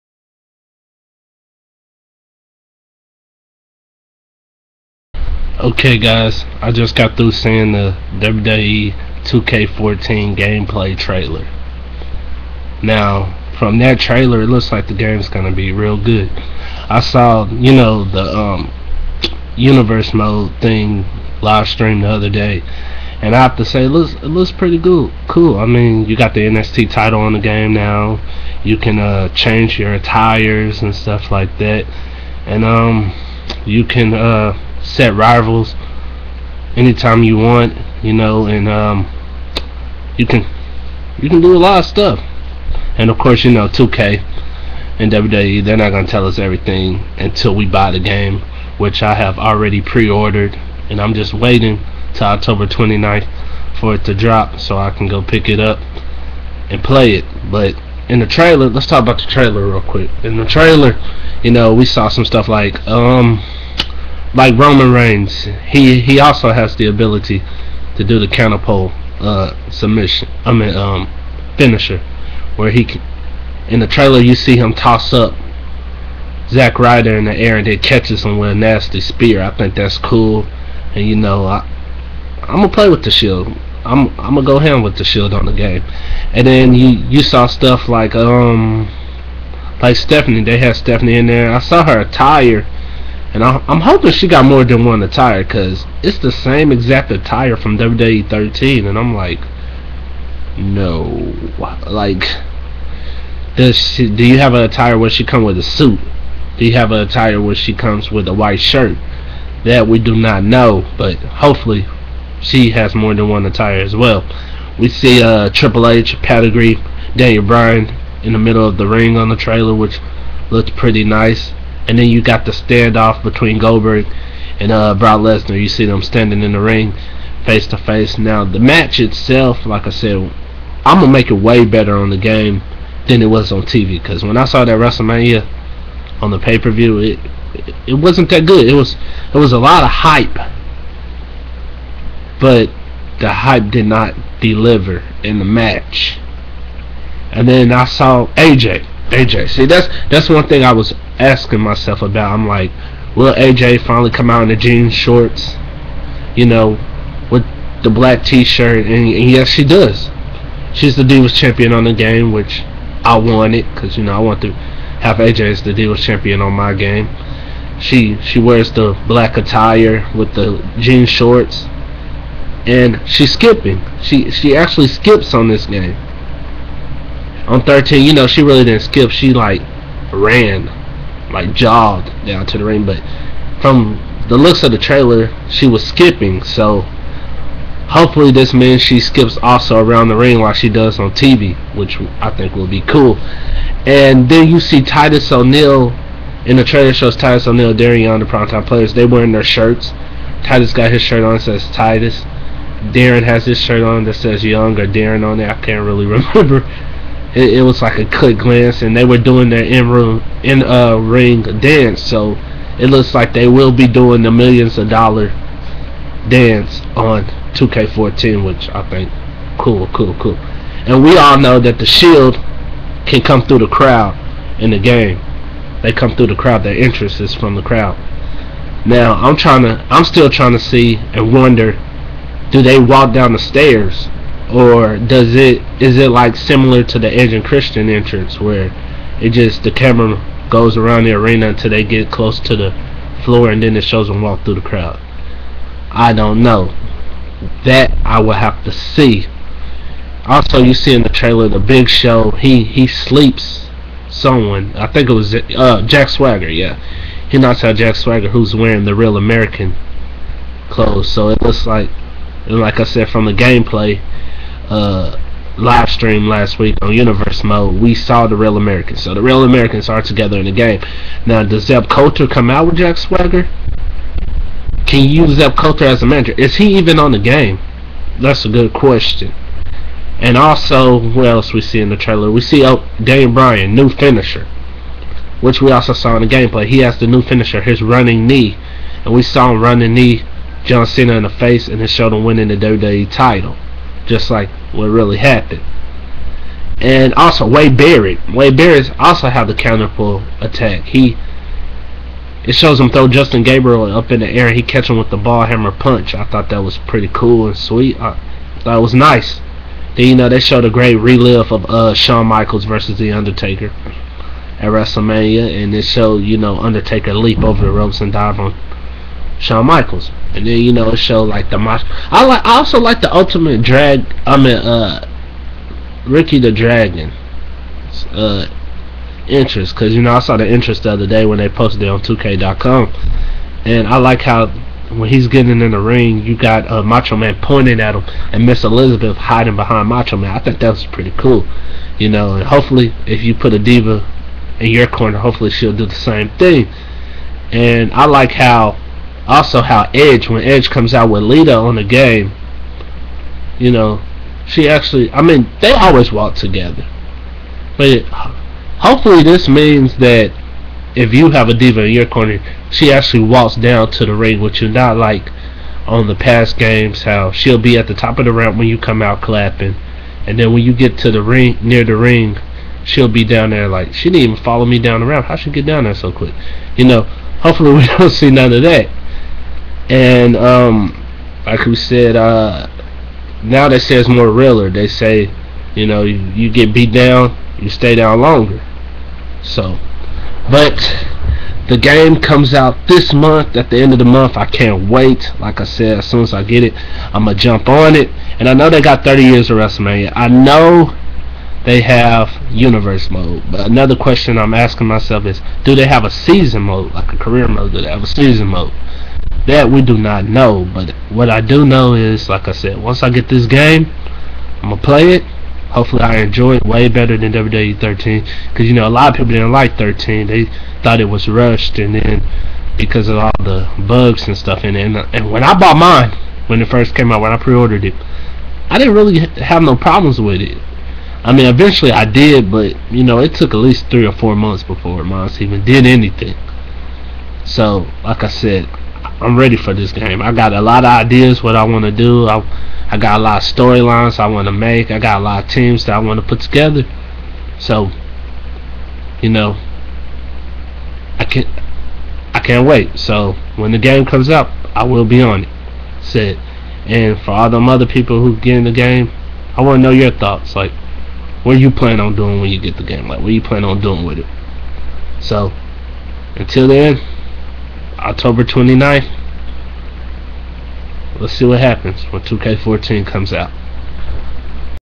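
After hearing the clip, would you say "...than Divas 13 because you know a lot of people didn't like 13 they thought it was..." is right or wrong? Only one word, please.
wrong.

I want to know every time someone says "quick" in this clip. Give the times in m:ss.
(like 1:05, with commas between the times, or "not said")
0:59, 3:28, 6:16.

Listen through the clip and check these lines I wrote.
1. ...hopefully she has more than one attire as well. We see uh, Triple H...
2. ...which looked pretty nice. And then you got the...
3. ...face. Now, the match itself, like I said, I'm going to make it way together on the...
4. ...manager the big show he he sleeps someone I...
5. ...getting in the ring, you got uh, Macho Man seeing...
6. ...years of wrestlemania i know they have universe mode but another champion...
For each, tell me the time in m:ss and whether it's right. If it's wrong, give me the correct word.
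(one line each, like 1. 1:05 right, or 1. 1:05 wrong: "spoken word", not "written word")
1. 1:51 right
2. 1:59 right
3. 2:07 wrong: "better", not "together"
4. 4:11 wrong: "trailer", not "manager"
5. 5:35 wrong: "pointing", not "seeing"
6. 6:39 wrong: "question", not "champion".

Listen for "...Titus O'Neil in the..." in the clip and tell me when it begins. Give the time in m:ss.
3:14.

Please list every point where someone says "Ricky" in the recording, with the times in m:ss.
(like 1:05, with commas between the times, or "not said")
5:26.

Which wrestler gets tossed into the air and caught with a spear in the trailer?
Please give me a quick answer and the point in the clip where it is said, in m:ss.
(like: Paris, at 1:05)
Zack Ryder, at 1:16.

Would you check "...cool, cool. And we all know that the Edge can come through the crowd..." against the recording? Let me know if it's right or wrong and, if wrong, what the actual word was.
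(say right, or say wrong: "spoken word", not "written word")
wrong: "Shield", not "Edge".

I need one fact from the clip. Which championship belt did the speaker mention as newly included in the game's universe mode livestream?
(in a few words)
NXT title.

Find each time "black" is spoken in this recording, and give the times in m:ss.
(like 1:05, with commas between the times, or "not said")
2:37, 2:49.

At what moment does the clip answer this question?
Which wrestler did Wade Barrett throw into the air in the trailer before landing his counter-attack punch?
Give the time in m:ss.
5:03.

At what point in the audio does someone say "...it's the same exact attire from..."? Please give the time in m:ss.
1:36.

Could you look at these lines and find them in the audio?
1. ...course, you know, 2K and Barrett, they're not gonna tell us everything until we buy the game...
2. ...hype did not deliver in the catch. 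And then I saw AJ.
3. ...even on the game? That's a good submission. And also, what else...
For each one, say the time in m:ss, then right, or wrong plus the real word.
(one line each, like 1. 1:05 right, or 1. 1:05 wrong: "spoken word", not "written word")
1. 0:43 wrong: "WWE", not "Barrett"
2. 2:23 wrong: "match", not "catch"
3. 4:36 wrong: "question", not "submission".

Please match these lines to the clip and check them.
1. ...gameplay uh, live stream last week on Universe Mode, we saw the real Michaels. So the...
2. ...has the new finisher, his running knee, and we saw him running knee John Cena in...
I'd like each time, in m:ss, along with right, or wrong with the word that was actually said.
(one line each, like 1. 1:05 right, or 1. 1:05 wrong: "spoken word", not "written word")
1. 4:23 wrong: "Americans", not "Michaels"
2. 4:46 right.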